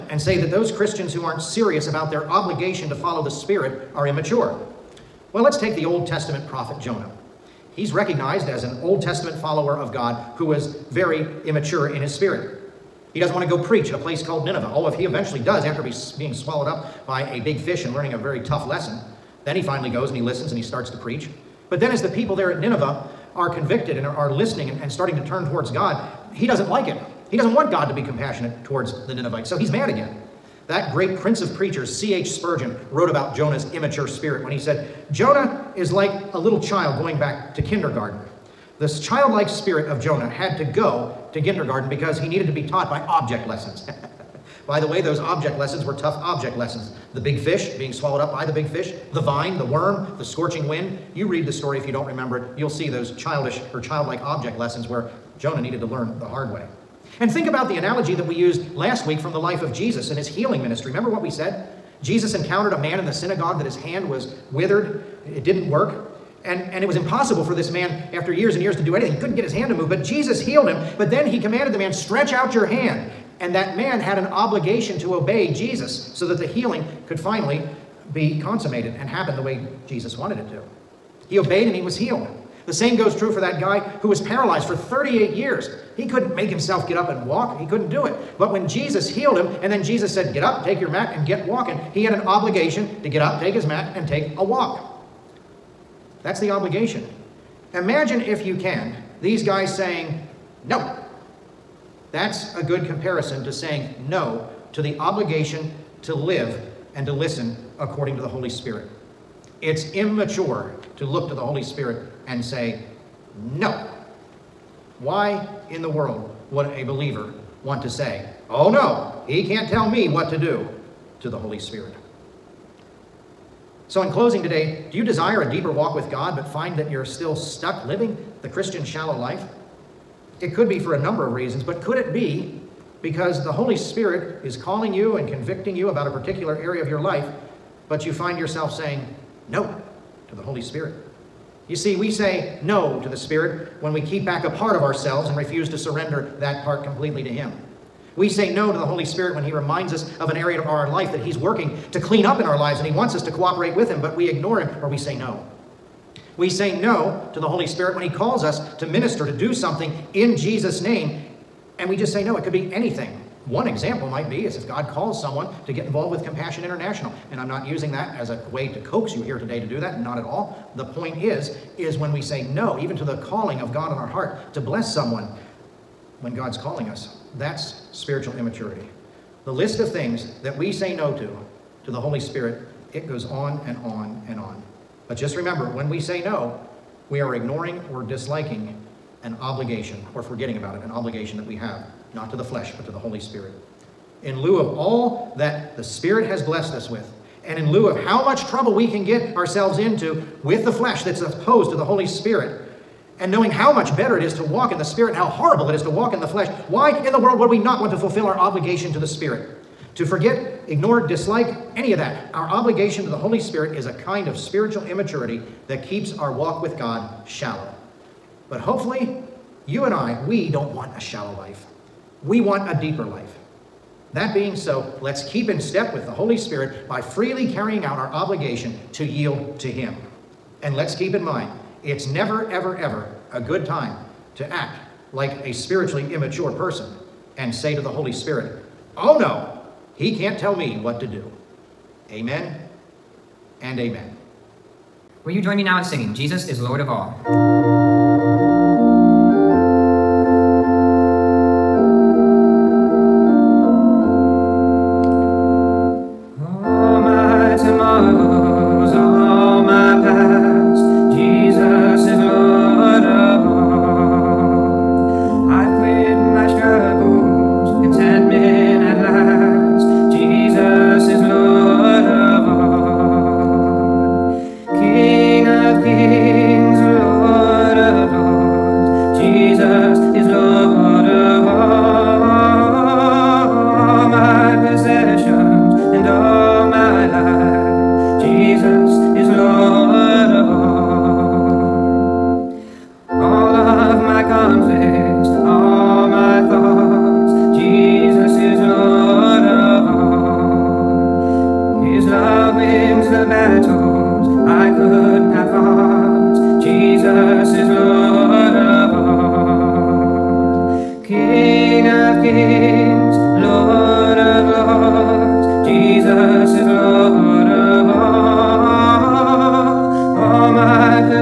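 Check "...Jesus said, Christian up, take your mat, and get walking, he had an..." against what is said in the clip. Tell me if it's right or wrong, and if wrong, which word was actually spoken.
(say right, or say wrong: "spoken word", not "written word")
wrong: "Get", not "Christian".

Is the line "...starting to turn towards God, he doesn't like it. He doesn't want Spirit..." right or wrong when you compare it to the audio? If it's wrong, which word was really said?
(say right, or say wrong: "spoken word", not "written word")
wrong: "God", not "Spirit".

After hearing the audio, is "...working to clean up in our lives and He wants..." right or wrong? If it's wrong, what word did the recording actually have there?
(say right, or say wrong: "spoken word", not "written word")
right.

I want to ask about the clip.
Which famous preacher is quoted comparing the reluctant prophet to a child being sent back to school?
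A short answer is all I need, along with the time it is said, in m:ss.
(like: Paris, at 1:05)
C.H. Spurgeon, at 0:31.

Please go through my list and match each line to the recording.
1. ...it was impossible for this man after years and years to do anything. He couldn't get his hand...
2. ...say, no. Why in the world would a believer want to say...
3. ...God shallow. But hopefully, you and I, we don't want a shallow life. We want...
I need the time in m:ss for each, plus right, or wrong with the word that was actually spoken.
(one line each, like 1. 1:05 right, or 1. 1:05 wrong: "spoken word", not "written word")
1. 1:06 right
2. 1:52 right
3. 3:36 right.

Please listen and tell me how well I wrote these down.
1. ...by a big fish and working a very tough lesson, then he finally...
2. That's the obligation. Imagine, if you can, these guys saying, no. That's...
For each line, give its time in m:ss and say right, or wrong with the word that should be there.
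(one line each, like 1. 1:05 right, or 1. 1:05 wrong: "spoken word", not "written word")
1. 0:17 wrong: "learning", not "working"
2. 1:36 right.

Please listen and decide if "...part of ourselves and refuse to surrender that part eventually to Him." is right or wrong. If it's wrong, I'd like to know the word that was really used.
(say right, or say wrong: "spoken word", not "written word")
wrong: "completely", not "eventually".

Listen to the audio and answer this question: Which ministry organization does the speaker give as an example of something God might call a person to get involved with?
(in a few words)
Compassion International.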